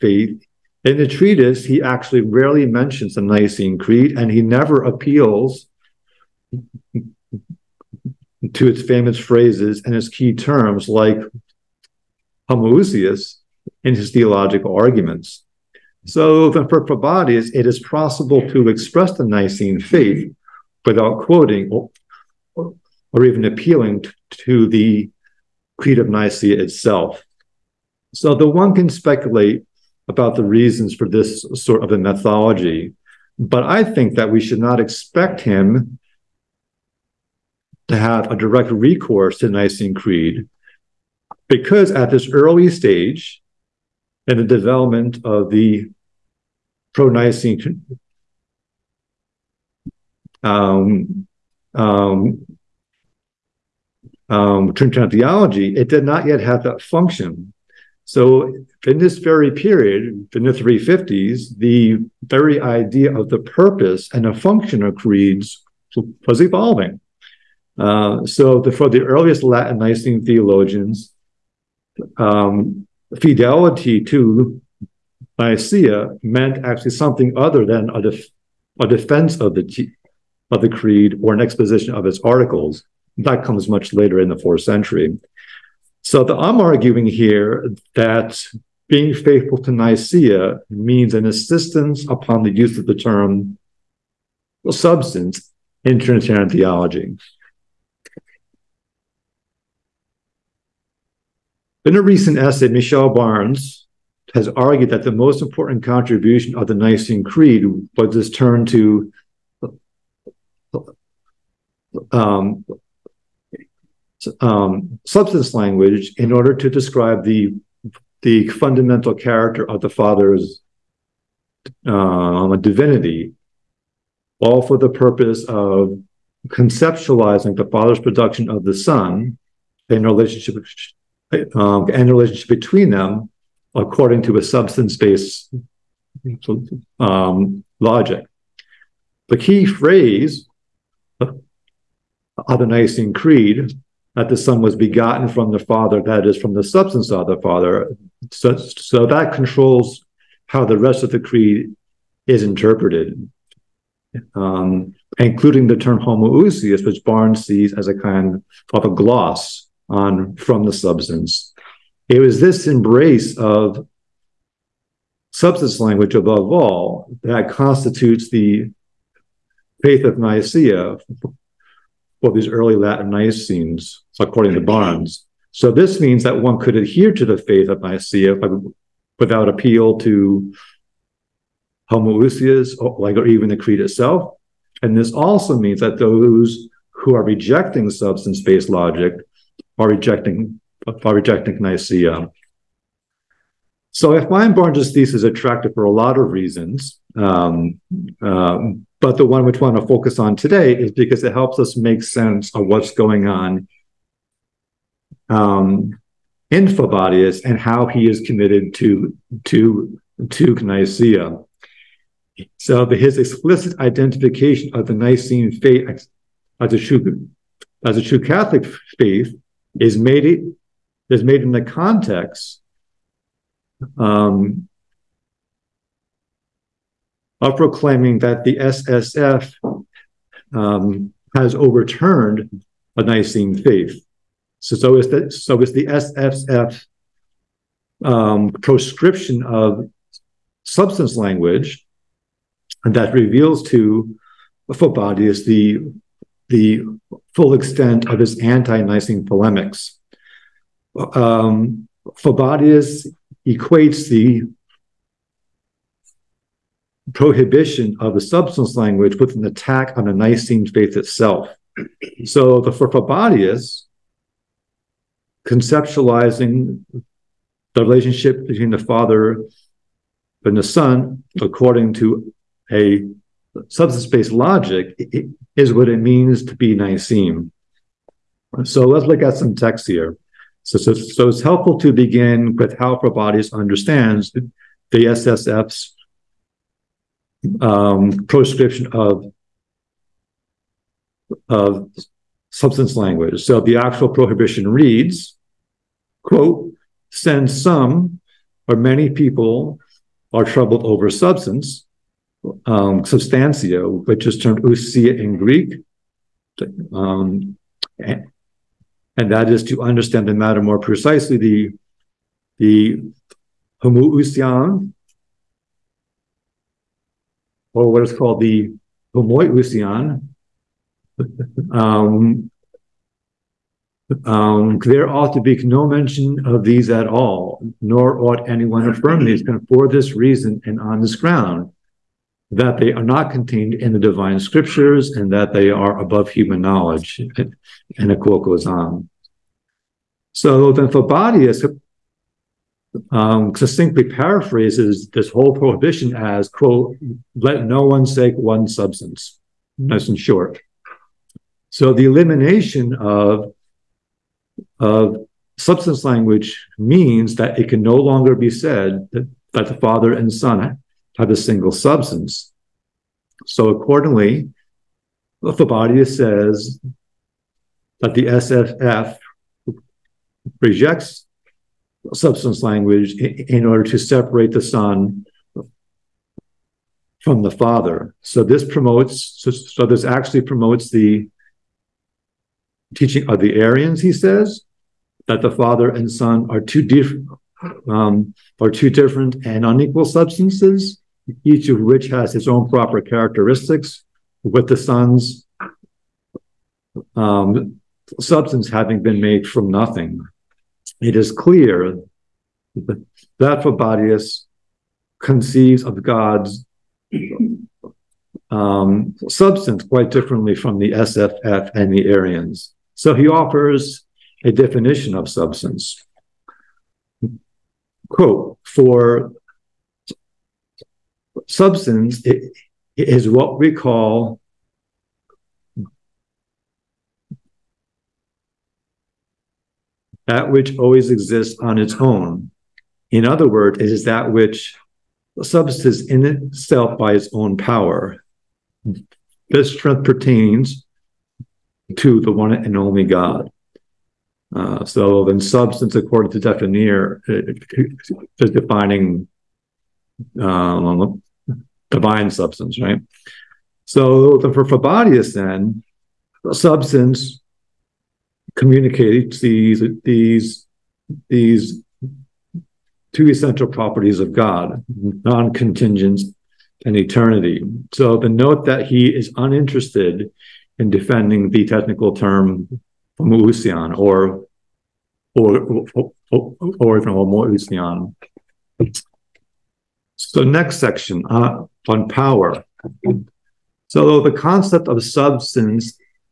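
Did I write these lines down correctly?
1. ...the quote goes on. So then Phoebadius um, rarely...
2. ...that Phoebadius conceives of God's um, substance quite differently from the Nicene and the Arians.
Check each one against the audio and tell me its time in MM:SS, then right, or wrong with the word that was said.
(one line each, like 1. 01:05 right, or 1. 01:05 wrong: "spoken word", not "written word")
1. 05:38 wrong: "succinctly", not "rarely"
2. 06:42 wrong: "SSF", not "Nicene".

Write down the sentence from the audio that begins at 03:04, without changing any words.
And this also means that those who are rejecting substance-based logic are rejecting are rejecting Nicaea.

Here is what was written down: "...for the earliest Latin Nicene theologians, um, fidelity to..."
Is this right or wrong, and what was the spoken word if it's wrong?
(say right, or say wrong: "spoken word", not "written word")
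right.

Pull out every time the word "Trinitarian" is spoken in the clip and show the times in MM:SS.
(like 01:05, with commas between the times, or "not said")
00:54, 01:35.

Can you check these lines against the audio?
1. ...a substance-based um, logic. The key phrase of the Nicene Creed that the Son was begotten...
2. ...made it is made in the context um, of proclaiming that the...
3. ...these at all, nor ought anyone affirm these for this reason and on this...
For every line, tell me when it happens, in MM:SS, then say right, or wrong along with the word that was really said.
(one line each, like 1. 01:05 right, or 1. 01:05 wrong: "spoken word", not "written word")
1. 02:14 right
2. 03:39 right
3. 05:26 right.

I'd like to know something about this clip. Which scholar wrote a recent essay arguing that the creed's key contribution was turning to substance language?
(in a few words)
Michel Barnes.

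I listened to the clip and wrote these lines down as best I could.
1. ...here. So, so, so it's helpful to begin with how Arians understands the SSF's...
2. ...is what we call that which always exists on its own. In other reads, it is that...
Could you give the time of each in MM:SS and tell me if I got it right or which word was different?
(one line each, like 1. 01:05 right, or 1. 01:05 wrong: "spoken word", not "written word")
1. 04:39 wrong: "Phoebadius", not "Arians"
2. 07:02 wrong: "words", not "reads".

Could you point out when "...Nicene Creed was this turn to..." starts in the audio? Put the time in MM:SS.
01:46.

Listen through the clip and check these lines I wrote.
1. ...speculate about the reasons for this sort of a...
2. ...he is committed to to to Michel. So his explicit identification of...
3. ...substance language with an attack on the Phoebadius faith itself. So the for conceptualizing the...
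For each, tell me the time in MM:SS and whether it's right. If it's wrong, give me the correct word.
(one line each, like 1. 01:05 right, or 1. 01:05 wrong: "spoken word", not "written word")
1. 00:28 right
2. 03:27 wrong: "Nicaea", not "Michel"
3. 04:18 wrong: "Nicene", not "Phoebadius".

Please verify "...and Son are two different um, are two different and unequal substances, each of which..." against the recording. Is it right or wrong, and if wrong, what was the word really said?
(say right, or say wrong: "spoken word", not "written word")
right.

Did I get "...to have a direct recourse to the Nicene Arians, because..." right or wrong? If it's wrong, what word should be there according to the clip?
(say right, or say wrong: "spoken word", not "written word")
wrong: "Creed", not "Arians".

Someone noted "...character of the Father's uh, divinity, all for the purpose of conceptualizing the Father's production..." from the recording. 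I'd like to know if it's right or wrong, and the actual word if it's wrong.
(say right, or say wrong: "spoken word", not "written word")
right.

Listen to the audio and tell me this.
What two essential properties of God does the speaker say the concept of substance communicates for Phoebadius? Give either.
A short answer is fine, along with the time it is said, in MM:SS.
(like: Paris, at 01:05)
non-contingence and eternity, at 07:45.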